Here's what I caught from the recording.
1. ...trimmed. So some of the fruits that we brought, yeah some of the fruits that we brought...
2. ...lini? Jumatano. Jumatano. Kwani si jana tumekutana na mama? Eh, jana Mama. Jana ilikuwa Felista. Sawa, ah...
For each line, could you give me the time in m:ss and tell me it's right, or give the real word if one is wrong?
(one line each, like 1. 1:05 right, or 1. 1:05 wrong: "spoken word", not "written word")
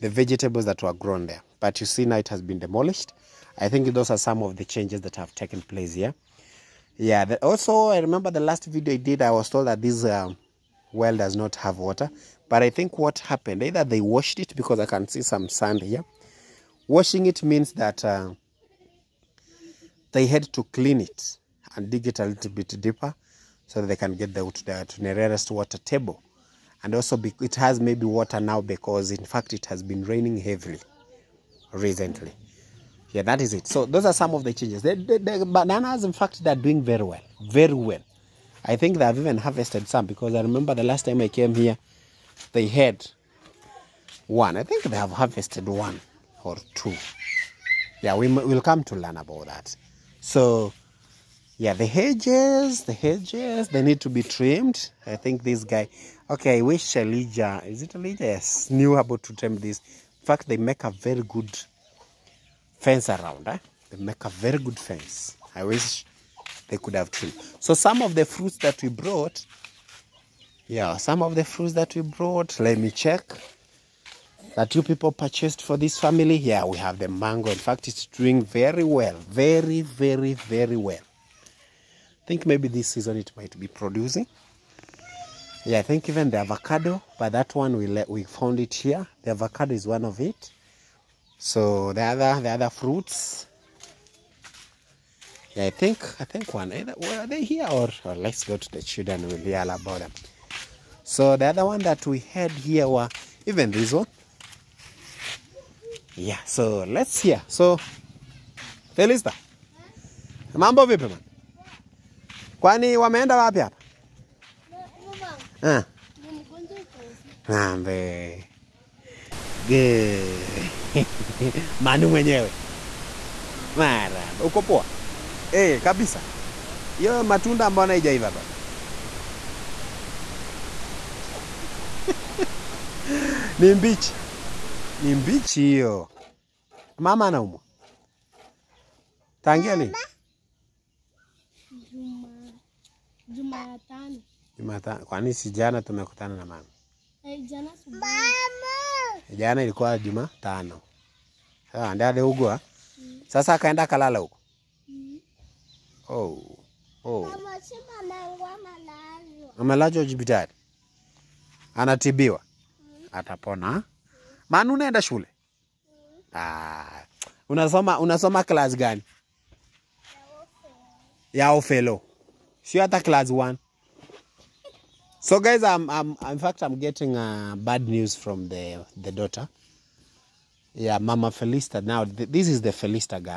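1. 1:07 right
2. 2:19 wrong: "Jumatano", not "Felista".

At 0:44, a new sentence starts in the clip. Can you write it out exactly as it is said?
I think they have harvested one or two.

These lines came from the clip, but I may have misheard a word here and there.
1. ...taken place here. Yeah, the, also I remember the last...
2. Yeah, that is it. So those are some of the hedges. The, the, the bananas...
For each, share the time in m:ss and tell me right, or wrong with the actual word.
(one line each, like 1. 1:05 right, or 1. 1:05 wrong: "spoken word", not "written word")
1. 0:05 right
2. 0:33 wrong: "changes", not "hedges".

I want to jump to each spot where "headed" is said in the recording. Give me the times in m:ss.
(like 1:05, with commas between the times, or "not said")
not said.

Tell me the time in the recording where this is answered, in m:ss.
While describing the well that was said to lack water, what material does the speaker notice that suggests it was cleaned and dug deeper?
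0:15.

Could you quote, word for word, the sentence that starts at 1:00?
In fact, they make a very good fence around.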